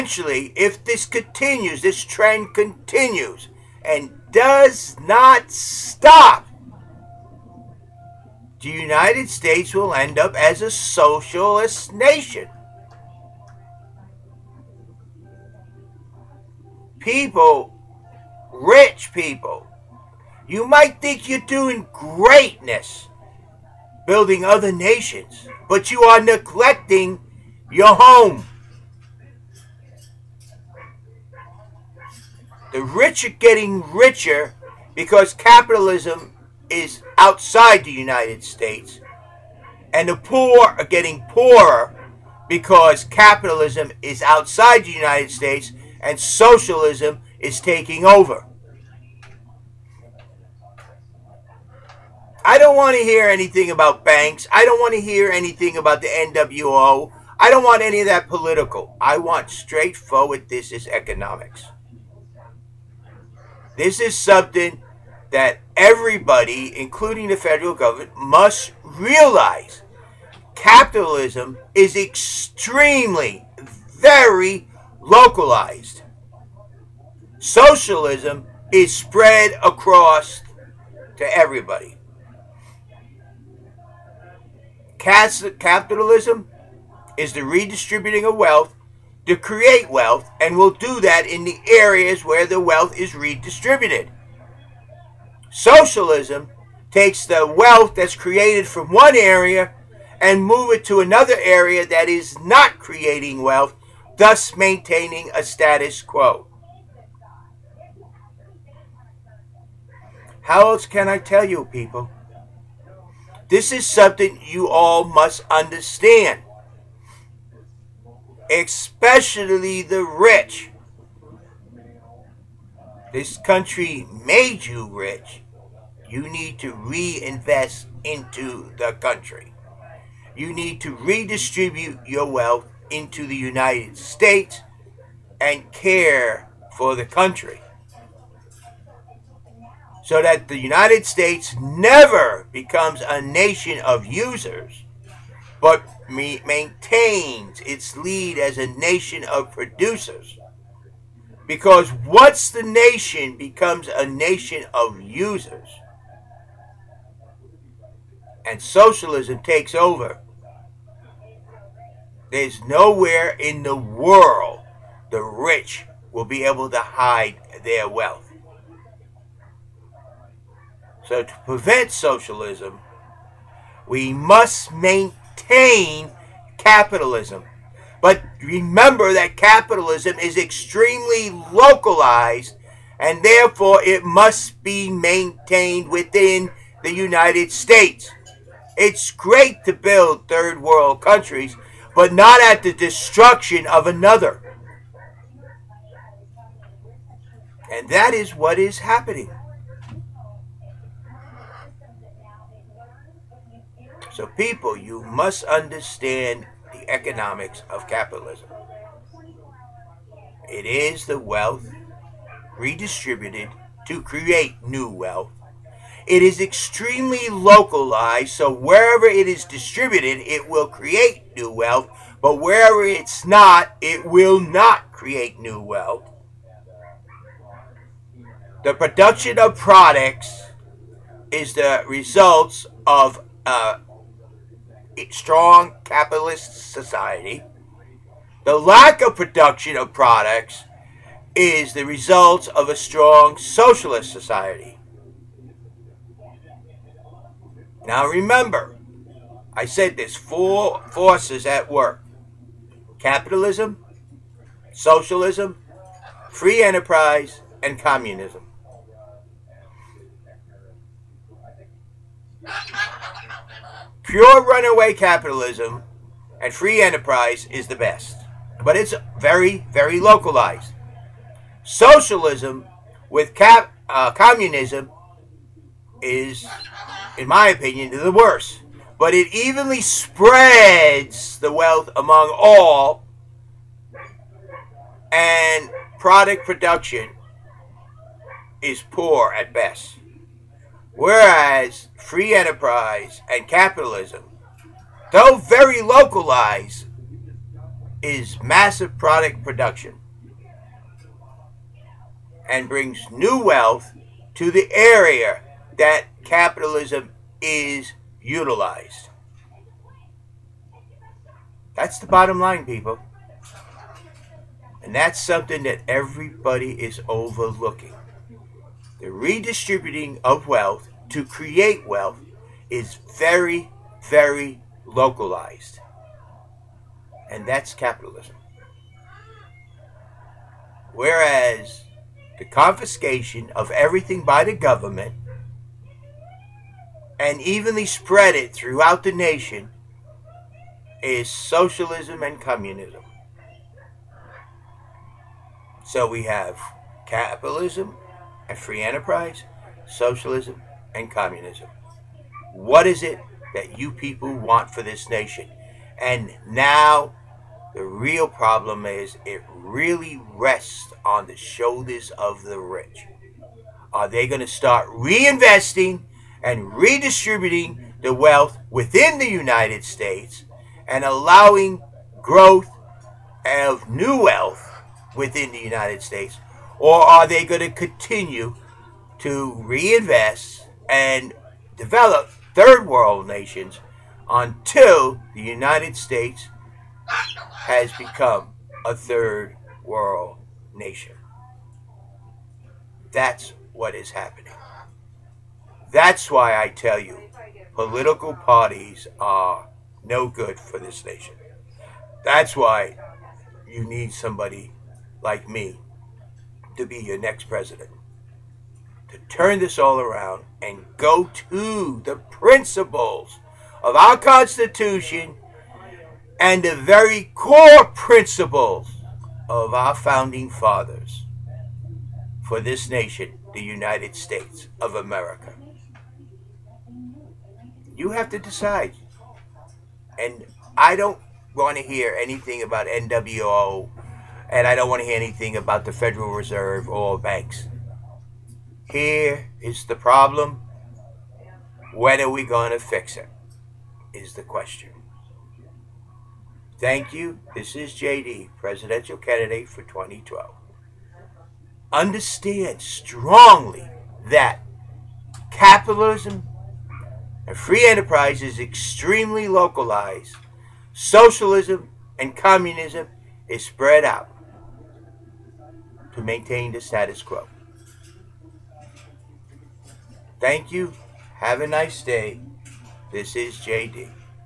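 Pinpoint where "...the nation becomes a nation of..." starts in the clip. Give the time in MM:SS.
02:32.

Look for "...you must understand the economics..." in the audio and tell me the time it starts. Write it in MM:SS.
03:24.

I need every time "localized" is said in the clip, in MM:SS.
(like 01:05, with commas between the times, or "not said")
01:14, 03:01, 03:37, 04:29, 04:55, 05:24, 07:39.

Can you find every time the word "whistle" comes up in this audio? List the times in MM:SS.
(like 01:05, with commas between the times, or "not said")
not said.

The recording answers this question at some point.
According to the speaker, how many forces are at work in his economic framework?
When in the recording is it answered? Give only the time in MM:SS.
04:10.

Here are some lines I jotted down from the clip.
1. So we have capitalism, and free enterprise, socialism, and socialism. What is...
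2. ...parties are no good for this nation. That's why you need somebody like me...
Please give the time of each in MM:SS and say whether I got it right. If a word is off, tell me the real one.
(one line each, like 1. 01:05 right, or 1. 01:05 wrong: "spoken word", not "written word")
1. 05:45 wrong: "communism", not "socialism"
2. 06:38 right.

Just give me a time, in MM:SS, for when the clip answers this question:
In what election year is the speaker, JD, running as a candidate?
07:29.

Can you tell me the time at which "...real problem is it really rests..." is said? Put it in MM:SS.
05:57.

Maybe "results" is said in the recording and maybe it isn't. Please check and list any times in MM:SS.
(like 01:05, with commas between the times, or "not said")
03:51, 04:01.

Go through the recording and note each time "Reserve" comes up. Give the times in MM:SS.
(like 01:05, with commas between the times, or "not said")
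07:16.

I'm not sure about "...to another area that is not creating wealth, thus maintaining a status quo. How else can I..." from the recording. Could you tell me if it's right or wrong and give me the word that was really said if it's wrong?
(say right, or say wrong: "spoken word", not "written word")
right.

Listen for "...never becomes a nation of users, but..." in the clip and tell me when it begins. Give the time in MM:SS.
02:21.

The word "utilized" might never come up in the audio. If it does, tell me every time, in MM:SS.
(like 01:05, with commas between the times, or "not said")
05:08.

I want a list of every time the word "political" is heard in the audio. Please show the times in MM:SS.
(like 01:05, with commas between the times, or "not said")
00:58, 06:37.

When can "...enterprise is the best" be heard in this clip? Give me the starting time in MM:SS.
04:26.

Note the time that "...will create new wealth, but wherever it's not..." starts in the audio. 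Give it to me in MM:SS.
03:40.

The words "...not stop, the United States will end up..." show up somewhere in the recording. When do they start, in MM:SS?
00:04.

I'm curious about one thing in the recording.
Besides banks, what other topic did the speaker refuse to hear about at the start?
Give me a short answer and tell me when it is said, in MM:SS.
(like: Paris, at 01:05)
the NWO, at 00:55.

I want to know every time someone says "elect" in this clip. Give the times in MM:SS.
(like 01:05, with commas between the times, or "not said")
not said.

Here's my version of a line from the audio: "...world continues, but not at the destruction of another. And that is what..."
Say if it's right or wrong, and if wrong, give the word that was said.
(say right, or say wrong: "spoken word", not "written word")
wrong: "countries", not "continues".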